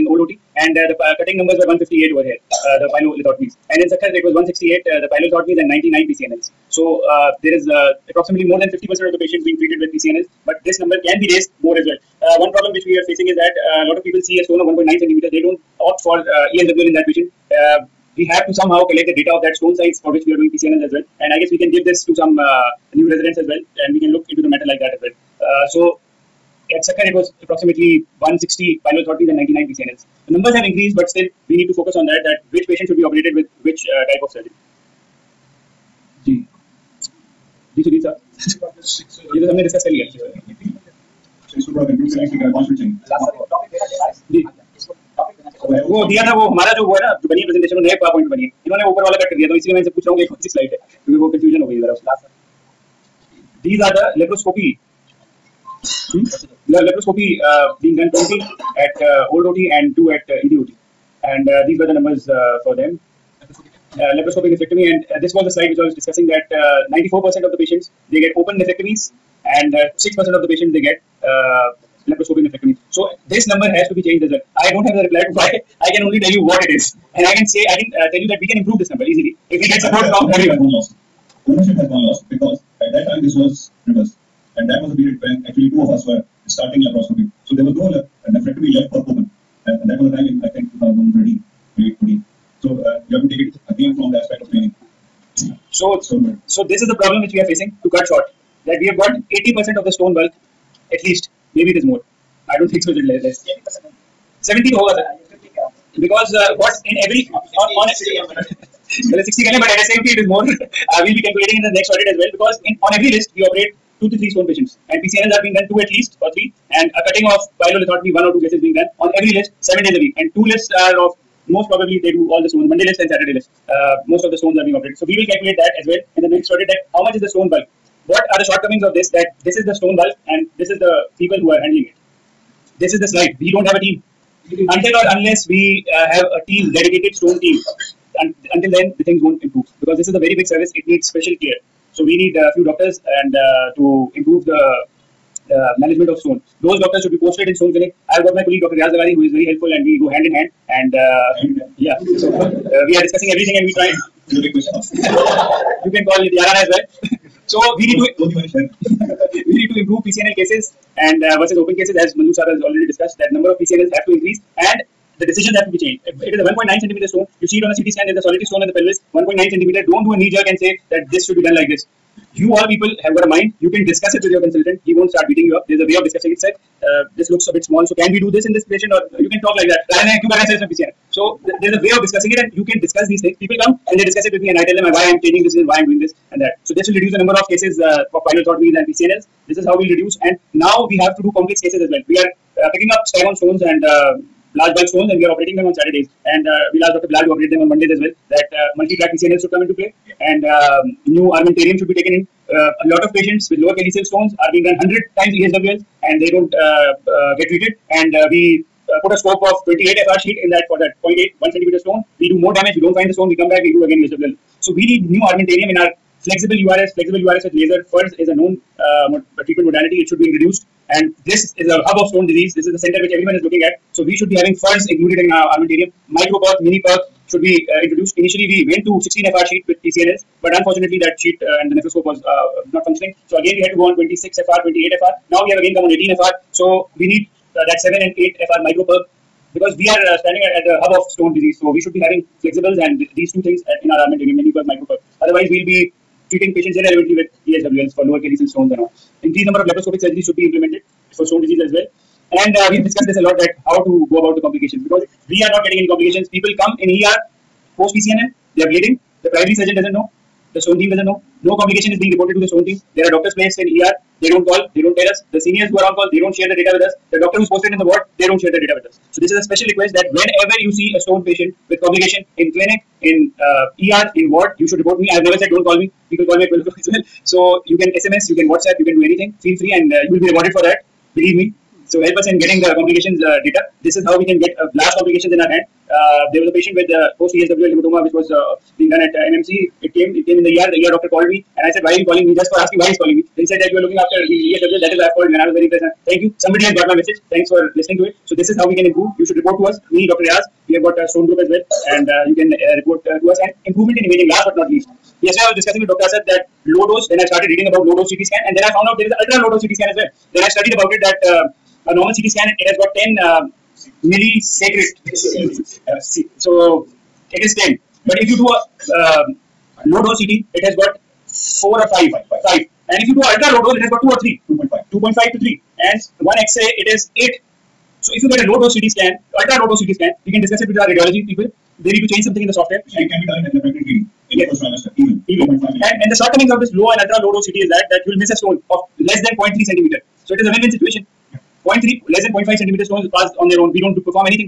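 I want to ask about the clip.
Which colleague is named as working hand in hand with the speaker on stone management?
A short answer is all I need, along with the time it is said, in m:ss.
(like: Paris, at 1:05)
Dr Riaz Leghari, at 2:28.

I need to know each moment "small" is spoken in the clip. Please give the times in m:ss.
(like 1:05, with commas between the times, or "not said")
2:57.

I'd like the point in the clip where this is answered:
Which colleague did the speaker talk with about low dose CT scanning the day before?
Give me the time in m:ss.
5:05.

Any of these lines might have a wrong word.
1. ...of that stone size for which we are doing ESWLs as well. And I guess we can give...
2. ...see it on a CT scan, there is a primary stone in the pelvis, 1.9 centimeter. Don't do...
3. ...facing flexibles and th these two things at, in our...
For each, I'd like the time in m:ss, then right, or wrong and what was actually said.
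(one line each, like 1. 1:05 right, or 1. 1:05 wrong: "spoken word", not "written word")
1. 0:19 wrong: "PCNs", not "ESWLs"
2. 2:47 wrong: "solitary", not "primary"
3. 4:02 wrong: "having", not "facing".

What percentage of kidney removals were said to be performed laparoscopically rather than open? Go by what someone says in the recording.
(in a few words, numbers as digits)
6%.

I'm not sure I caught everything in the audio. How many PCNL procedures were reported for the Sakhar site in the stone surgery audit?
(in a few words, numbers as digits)
99.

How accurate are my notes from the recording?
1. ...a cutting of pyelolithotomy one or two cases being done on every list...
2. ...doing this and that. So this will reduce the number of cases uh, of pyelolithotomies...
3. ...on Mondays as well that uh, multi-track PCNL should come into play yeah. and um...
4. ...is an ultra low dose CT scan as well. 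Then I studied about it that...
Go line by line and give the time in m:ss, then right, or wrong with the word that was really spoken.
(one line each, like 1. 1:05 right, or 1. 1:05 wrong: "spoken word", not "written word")
1. 1:56 right
2. 3:05 right
3. 3:17 right
4. 5:09 right.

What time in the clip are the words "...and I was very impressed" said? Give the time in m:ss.
4:55.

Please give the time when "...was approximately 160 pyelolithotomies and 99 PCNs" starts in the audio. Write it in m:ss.
0:27.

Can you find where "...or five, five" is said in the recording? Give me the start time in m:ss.
5:21.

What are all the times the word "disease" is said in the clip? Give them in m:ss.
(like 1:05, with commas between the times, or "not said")
3:42, 4:01, 4:11.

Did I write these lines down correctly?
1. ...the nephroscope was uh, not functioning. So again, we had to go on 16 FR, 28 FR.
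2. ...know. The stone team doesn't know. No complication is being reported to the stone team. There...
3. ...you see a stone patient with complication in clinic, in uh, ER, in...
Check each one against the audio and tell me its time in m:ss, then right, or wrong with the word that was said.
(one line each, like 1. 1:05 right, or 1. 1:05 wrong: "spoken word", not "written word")
1. 3:51 wrong: "26", not "16"
2. 4:19 right
3. 4:30 right.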